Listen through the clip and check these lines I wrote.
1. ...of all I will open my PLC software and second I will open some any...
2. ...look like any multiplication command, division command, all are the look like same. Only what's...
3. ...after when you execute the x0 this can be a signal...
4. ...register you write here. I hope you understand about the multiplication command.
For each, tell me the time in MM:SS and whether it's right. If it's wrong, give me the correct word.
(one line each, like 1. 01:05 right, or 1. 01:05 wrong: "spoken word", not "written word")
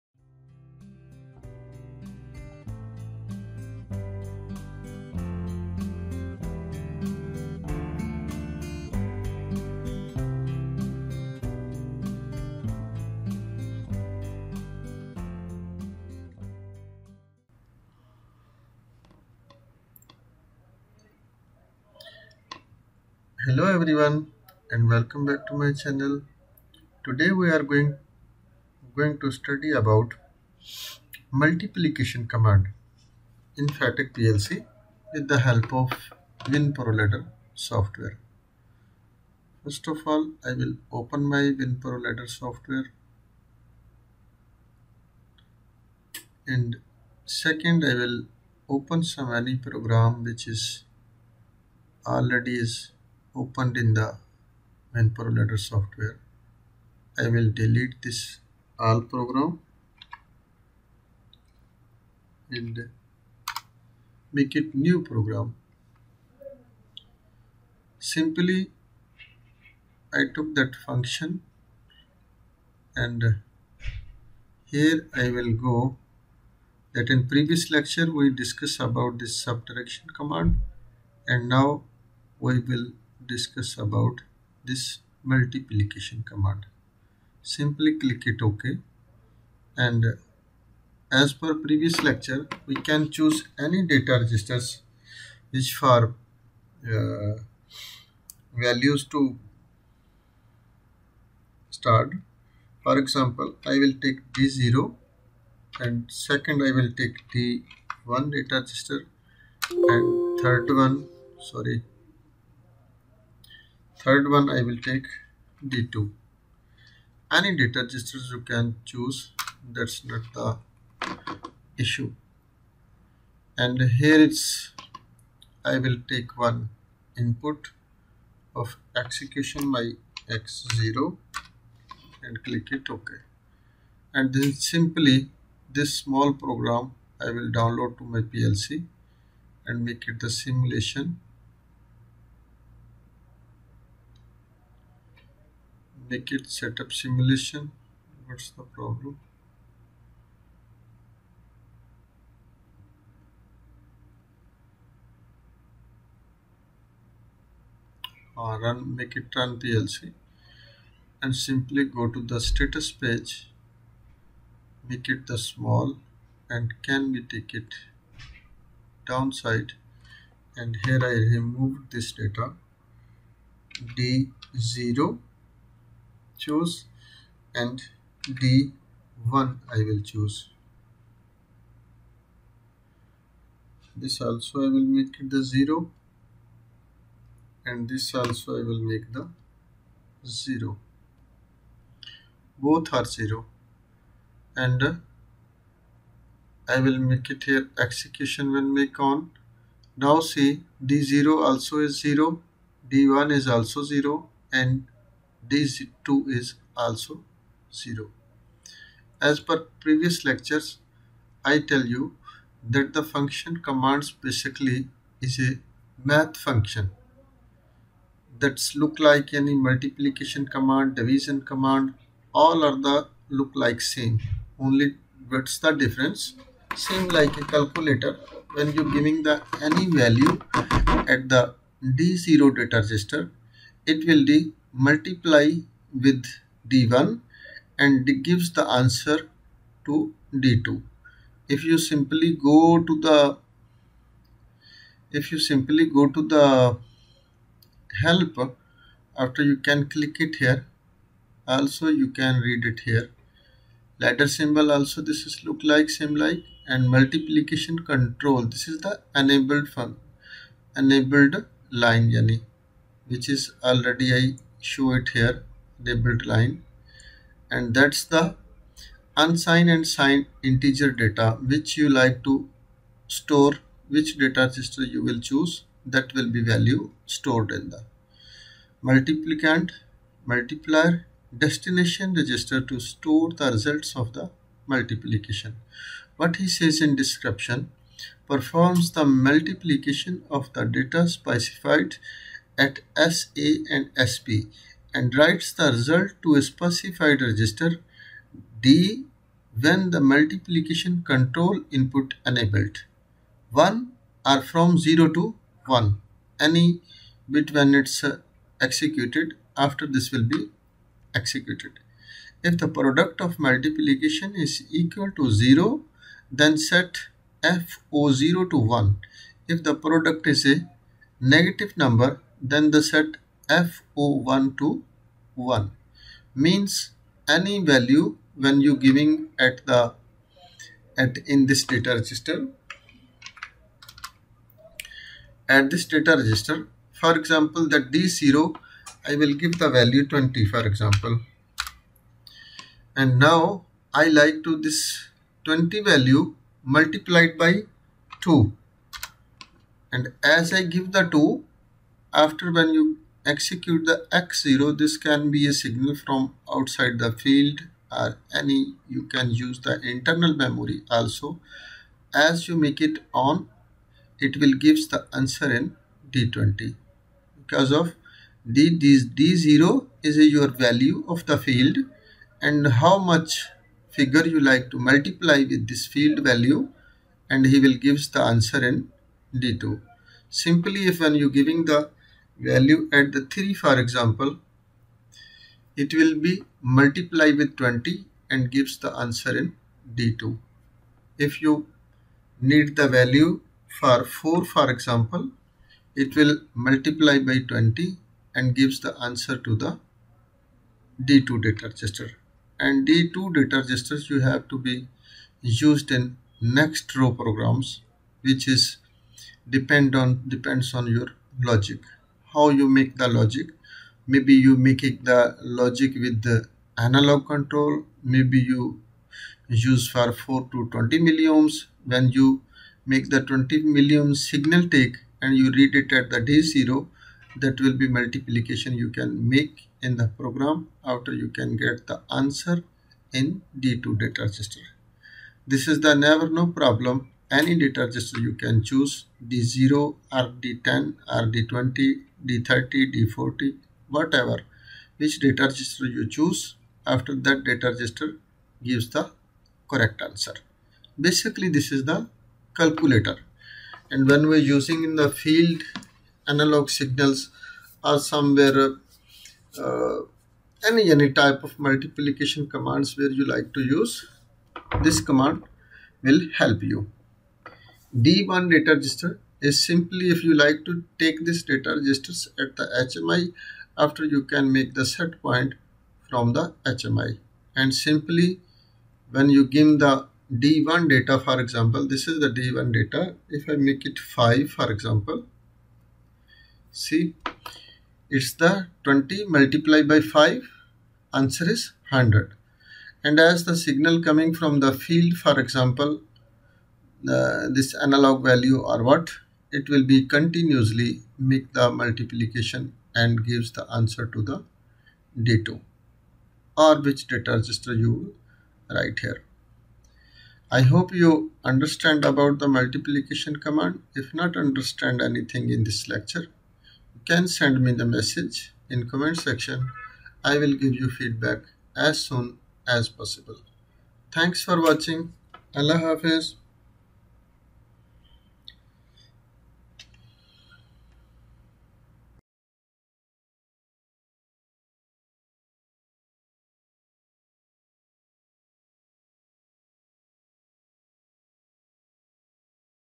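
1. 00:39 wrong: "WinProLadder", not "PLC"
2. 03:38 right
3. 05:52 right
4. 08:27 right.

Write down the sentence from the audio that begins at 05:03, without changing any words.
1 are from 0 to 1 any bit when it's uh, executed after this will be executed.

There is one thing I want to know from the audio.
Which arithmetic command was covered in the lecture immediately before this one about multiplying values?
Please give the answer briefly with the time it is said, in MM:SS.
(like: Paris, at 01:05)
subtraction, at 01:19.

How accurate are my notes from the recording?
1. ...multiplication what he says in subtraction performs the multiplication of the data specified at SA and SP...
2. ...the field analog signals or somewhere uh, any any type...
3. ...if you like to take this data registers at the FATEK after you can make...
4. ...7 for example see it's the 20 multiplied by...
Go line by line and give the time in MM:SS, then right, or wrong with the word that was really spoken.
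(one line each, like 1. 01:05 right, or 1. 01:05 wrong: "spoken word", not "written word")
1. 04:44 wrong: "description", not "subtraction"
2. 07:34 right
3. 07:50 wrong: "HMI", not "FATEK"
4. 08:03 wrong: "5", not "7".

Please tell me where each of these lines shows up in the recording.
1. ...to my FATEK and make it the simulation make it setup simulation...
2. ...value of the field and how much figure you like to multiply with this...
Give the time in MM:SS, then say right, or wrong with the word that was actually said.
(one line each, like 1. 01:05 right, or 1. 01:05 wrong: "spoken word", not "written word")
1. 02:17 wrong: "PLC", not "FATEK"
2. 06:10 right.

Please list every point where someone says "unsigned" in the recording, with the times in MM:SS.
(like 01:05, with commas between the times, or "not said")
04:29.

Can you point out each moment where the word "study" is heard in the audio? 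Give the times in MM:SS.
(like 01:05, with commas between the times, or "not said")
00:29.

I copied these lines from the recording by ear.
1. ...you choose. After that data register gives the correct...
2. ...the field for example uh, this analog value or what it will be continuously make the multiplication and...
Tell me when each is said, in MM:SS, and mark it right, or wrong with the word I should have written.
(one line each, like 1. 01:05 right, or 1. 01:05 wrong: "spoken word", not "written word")
1. 07:25 right
2. 08:14 right.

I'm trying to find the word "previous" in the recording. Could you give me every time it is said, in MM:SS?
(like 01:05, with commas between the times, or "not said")
01:17, 01:31, 03:29.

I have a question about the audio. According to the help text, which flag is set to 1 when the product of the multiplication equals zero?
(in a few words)
F0.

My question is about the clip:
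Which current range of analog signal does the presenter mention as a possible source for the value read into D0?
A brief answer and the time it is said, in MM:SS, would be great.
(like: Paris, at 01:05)
4 to 20 milliamps, at 07:00.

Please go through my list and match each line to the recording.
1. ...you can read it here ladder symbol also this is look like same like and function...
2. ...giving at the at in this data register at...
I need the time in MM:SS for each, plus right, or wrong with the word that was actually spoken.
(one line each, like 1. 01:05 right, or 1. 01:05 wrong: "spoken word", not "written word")
1. 04:11 wrong: "multiplication", not "function"
2. 05:28 right.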